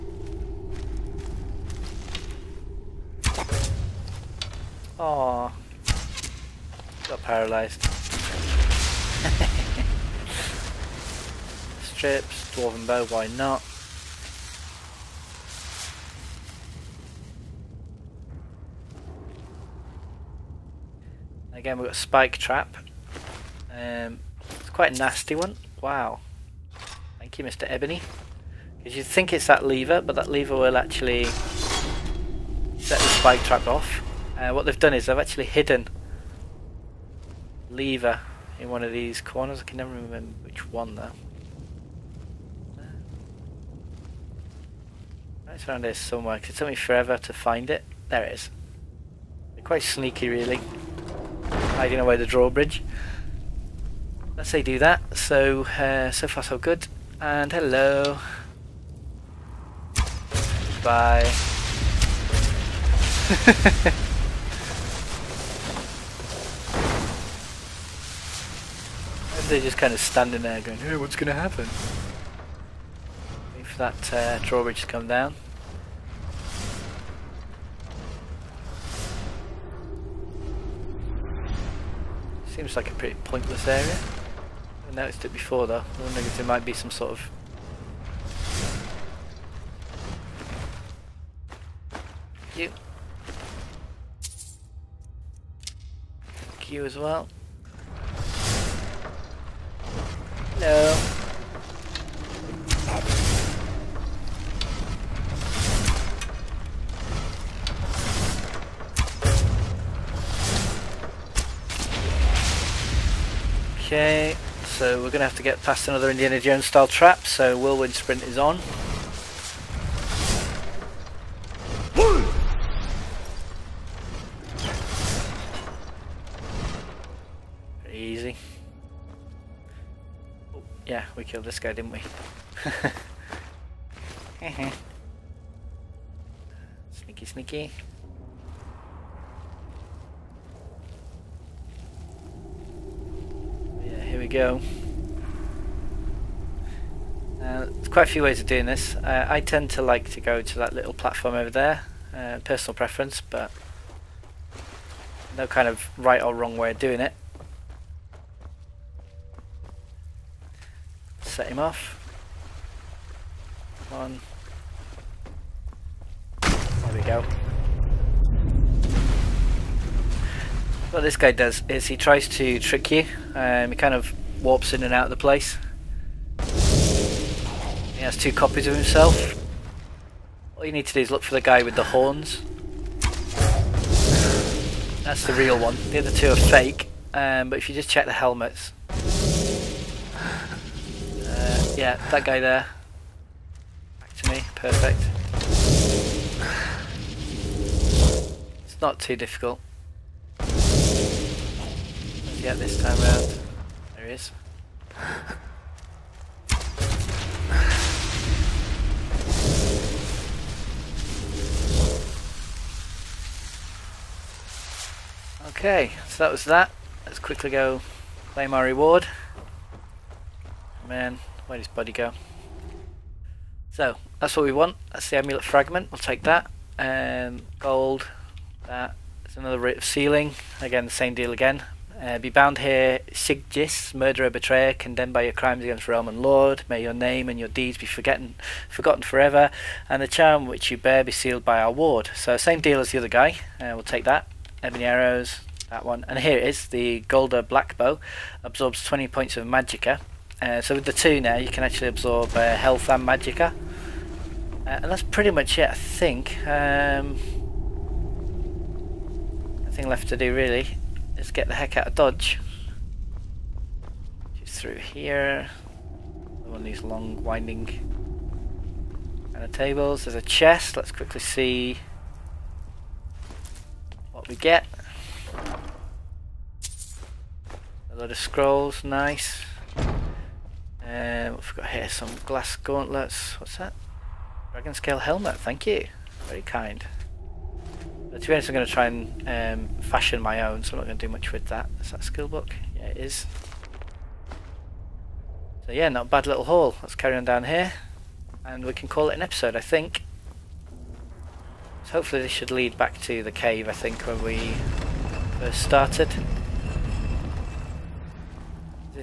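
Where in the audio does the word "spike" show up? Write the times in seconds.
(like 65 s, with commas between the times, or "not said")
21 s, 33 s.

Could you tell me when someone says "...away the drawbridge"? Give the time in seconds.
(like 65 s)
51 s.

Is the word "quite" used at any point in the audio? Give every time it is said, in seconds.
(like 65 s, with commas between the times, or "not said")
24 s, 49 s, 147 s.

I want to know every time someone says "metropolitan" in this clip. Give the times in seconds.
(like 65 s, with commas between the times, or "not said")
not said.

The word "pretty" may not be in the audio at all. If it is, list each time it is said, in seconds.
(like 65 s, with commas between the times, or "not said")
82 s, 255 s.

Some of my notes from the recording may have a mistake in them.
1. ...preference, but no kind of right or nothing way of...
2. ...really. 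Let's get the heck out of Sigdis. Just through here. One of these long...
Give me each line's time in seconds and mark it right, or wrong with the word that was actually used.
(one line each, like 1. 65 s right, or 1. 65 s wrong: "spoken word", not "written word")
1. 152 s wrong: "wrong", not "nothing"
2. 260 s wrong: "Dodge", not "Sigdis".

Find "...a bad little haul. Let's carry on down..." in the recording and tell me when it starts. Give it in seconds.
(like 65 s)
296 s.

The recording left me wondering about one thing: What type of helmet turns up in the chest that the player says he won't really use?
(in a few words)
Dragon scale helmet.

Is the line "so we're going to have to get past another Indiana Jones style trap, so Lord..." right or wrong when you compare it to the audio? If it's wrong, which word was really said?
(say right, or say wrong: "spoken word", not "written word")
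wrong: "Whirlwind", not "Lord".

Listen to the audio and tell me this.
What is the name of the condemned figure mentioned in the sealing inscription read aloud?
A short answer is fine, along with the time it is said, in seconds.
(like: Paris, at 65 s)
Sigdis, at 233 s.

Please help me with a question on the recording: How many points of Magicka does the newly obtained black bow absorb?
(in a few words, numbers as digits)
20.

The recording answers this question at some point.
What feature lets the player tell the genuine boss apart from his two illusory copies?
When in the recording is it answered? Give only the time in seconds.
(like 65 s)
181 s.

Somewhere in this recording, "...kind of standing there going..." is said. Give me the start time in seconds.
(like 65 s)
69 s.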